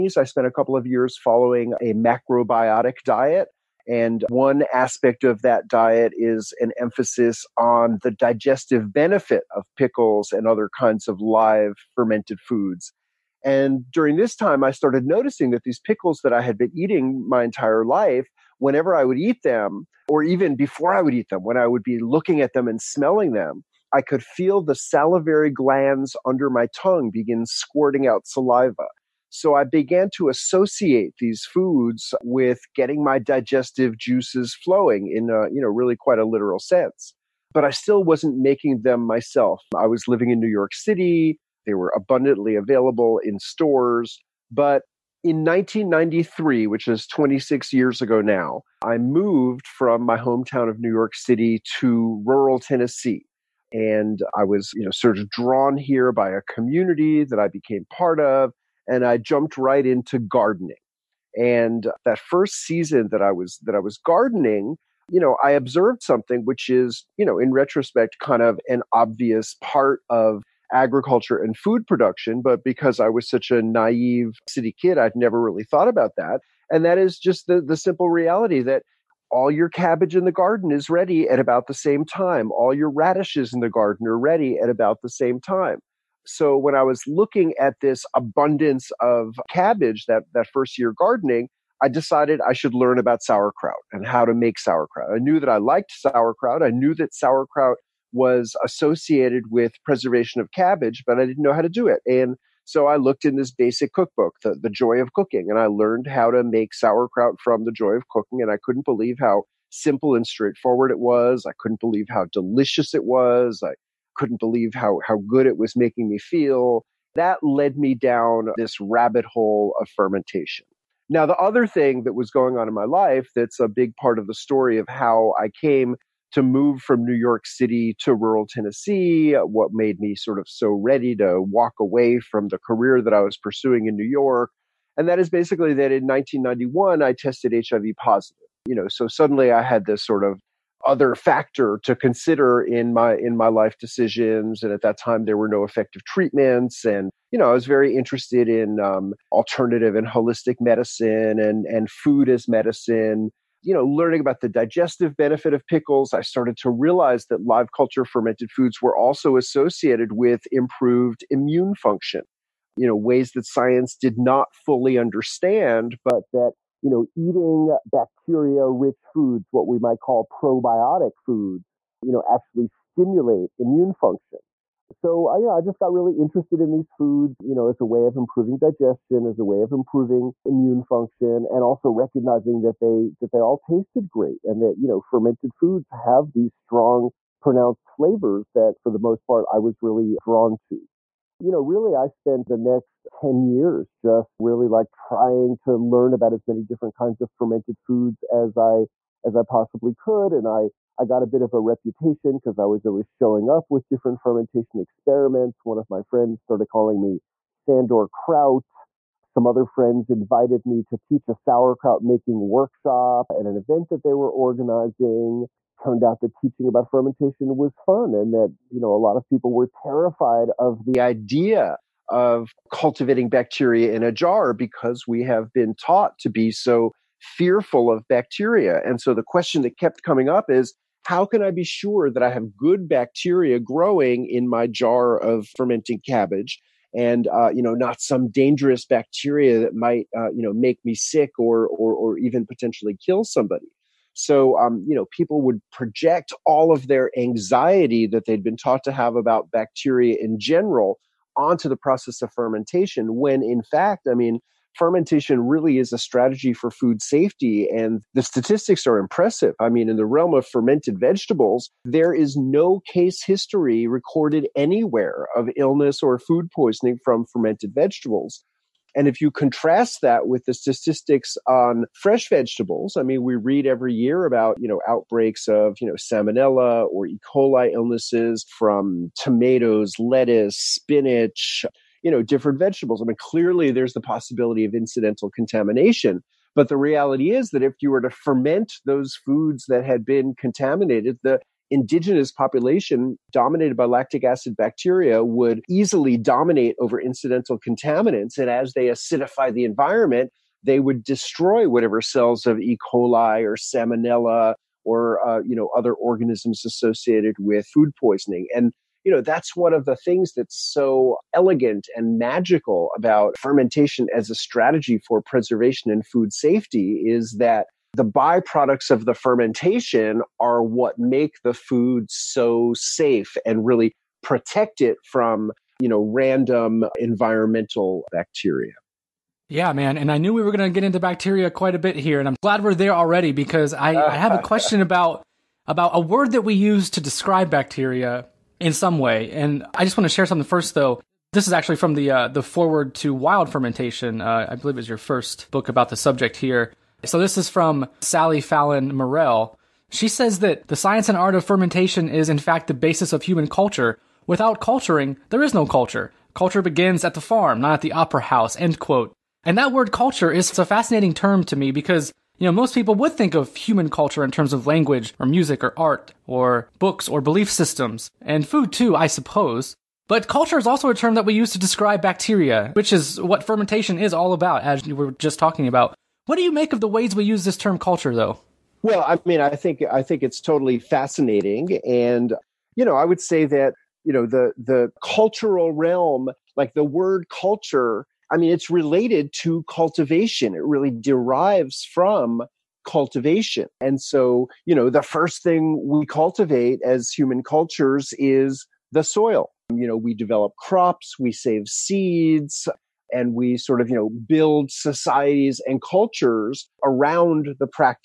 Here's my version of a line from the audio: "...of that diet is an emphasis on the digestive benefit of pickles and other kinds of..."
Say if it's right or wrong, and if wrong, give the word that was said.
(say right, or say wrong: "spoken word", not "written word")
right.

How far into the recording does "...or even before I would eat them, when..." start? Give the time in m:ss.
0:20.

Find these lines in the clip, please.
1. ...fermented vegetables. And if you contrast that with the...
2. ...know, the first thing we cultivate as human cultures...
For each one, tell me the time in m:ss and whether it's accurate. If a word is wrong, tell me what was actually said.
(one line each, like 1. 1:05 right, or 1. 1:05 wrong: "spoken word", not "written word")
1. 4:27 right
2. 6:34 right.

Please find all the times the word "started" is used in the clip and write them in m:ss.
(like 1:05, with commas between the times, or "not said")
0:14, 2:36, 3:26.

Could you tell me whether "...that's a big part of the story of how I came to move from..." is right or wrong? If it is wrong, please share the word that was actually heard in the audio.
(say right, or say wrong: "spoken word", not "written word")
right.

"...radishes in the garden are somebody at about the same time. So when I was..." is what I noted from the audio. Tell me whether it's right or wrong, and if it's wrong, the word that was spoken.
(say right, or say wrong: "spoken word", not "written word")
wrong: "ready", not "somebody".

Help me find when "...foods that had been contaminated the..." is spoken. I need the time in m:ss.
4:49.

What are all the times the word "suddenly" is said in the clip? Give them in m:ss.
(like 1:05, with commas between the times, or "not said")
2:19.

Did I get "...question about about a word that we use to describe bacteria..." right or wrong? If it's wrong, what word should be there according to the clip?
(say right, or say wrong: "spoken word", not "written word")
right.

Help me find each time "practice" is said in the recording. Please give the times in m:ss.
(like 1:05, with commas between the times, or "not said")
not said.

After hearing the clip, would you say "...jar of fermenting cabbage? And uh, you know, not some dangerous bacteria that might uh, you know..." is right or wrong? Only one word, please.
right.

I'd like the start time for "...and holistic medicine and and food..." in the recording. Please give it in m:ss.
2:29.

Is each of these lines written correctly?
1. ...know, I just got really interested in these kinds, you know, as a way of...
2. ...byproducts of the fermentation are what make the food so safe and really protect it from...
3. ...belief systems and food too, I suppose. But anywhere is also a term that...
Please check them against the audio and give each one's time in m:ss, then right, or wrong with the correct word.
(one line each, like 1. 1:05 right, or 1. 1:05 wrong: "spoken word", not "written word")
1. 2:55 wrong: "foods", not "kinds"
2. 5:18 right
3. 6:07 wrong: "culture", not "anywhere".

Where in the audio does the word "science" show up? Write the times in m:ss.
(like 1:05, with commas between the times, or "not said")
2:43, 5:50.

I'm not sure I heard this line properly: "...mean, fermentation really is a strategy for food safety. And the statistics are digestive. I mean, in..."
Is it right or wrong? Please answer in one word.
wrong.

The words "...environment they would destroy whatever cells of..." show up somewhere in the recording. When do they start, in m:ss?
4:59.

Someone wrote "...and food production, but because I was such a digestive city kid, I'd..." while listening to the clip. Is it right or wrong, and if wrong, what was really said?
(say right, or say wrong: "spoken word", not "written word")
wrong: "naive", not "digestive".